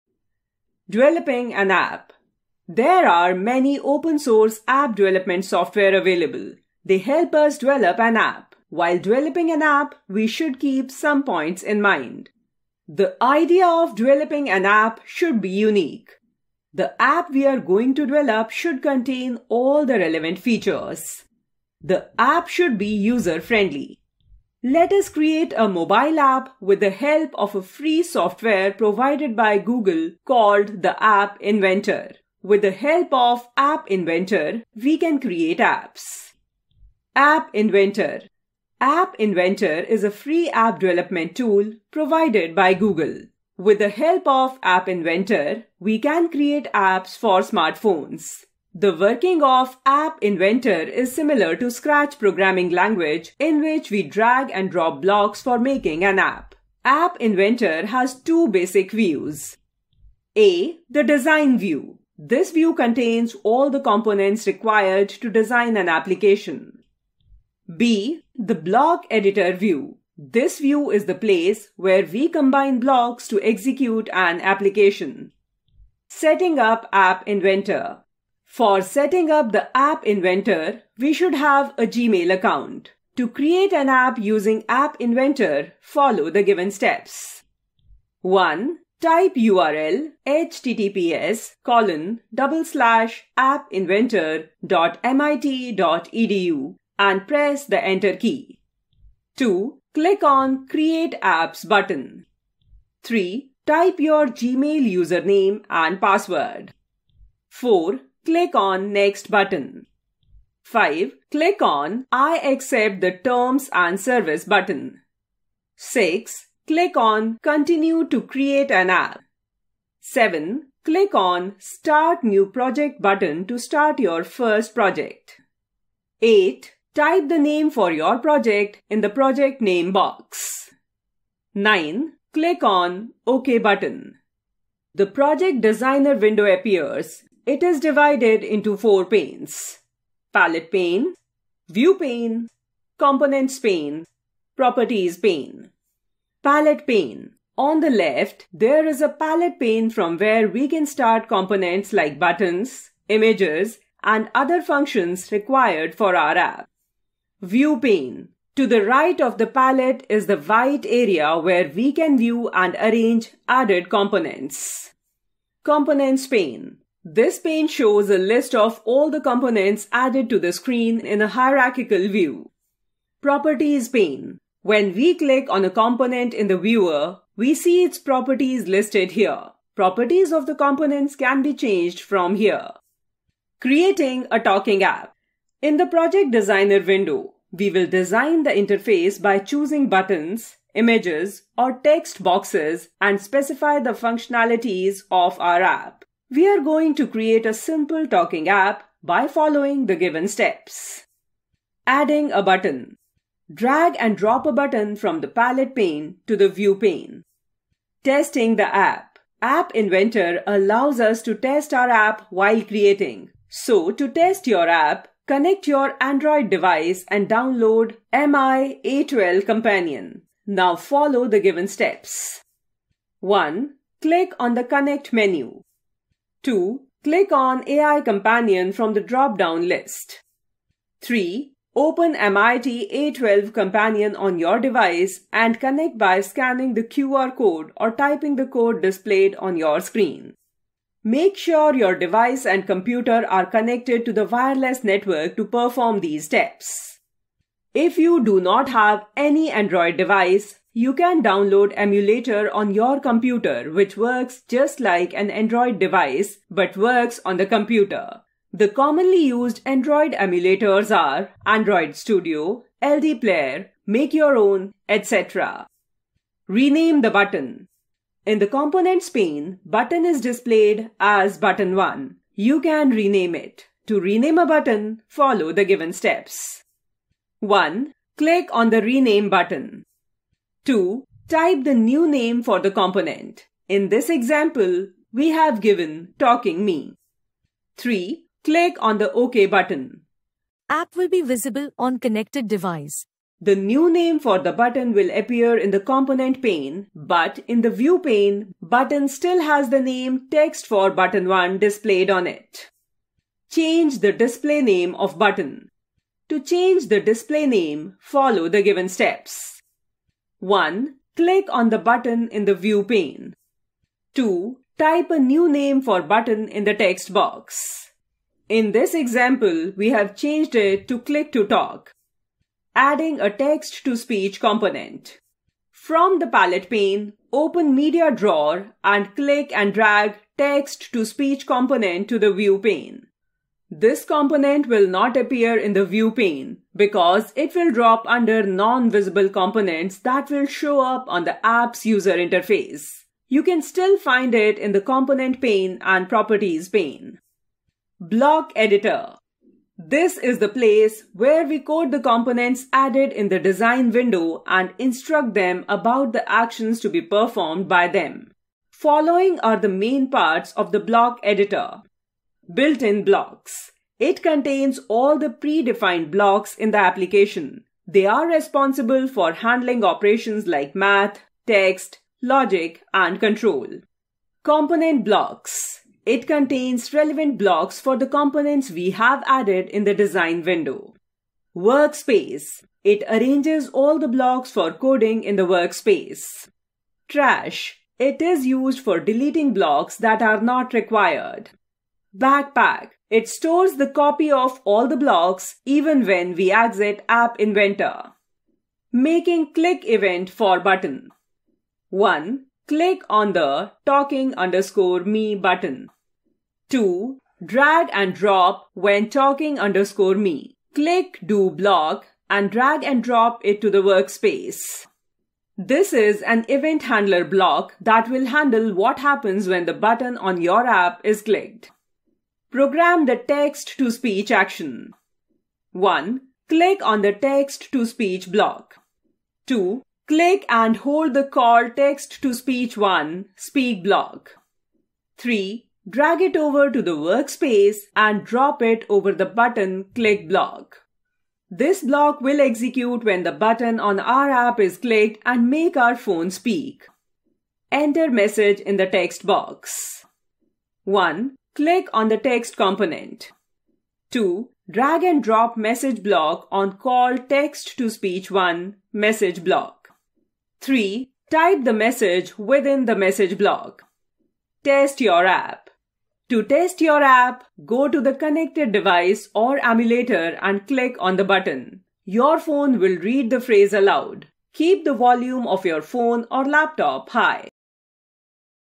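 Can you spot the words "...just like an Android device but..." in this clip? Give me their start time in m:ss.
4:14.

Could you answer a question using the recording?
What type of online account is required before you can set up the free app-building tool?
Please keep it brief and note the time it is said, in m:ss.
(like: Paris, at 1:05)
Gmail account, at 1:21.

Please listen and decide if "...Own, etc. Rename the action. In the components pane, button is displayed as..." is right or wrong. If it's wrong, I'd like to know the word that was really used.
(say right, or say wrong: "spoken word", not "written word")
wrong: "button", not "action".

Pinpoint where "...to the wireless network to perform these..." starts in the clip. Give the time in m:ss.
4:04.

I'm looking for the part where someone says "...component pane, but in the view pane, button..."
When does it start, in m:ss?
4:55.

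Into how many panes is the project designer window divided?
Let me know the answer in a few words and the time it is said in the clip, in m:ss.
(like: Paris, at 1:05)
4, at 2:18.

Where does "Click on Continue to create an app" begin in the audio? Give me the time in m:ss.
1:56.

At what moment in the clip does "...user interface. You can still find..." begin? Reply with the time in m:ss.
5:41.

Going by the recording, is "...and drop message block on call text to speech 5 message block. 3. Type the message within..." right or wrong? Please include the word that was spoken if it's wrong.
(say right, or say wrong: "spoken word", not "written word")
wrong: "1", not "5".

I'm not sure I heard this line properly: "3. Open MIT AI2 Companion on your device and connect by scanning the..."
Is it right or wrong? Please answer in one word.
right.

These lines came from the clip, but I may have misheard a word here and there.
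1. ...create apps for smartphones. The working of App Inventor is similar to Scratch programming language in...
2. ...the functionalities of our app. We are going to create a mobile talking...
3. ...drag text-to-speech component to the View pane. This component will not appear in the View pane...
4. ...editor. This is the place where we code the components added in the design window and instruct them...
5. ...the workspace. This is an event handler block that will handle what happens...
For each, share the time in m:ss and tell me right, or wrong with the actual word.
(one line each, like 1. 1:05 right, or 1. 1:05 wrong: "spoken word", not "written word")
1. 0:46 right
2. 3:13 wrong: "simple", not "mobile"
3. 5:29 right
4. 5:48 right
5. 6:53 right.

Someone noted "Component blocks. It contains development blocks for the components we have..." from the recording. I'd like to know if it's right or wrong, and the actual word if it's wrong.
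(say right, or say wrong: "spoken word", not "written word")
wrong: "relevant", not "development".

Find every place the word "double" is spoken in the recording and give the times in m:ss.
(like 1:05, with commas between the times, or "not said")
1:32.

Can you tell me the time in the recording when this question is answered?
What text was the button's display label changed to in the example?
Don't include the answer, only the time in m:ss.
5:20.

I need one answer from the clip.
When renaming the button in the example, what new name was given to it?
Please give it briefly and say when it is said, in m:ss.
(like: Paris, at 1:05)
talking me, at 4:46.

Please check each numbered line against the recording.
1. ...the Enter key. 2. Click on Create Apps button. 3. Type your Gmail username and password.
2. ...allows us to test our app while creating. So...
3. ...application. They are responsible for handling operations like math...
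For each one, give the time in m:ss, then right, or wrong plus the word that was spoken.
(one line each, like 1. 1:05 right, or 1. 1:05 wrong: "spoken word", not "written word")
1. 1:37 right
2. 3:30 right
3. 6:06 right.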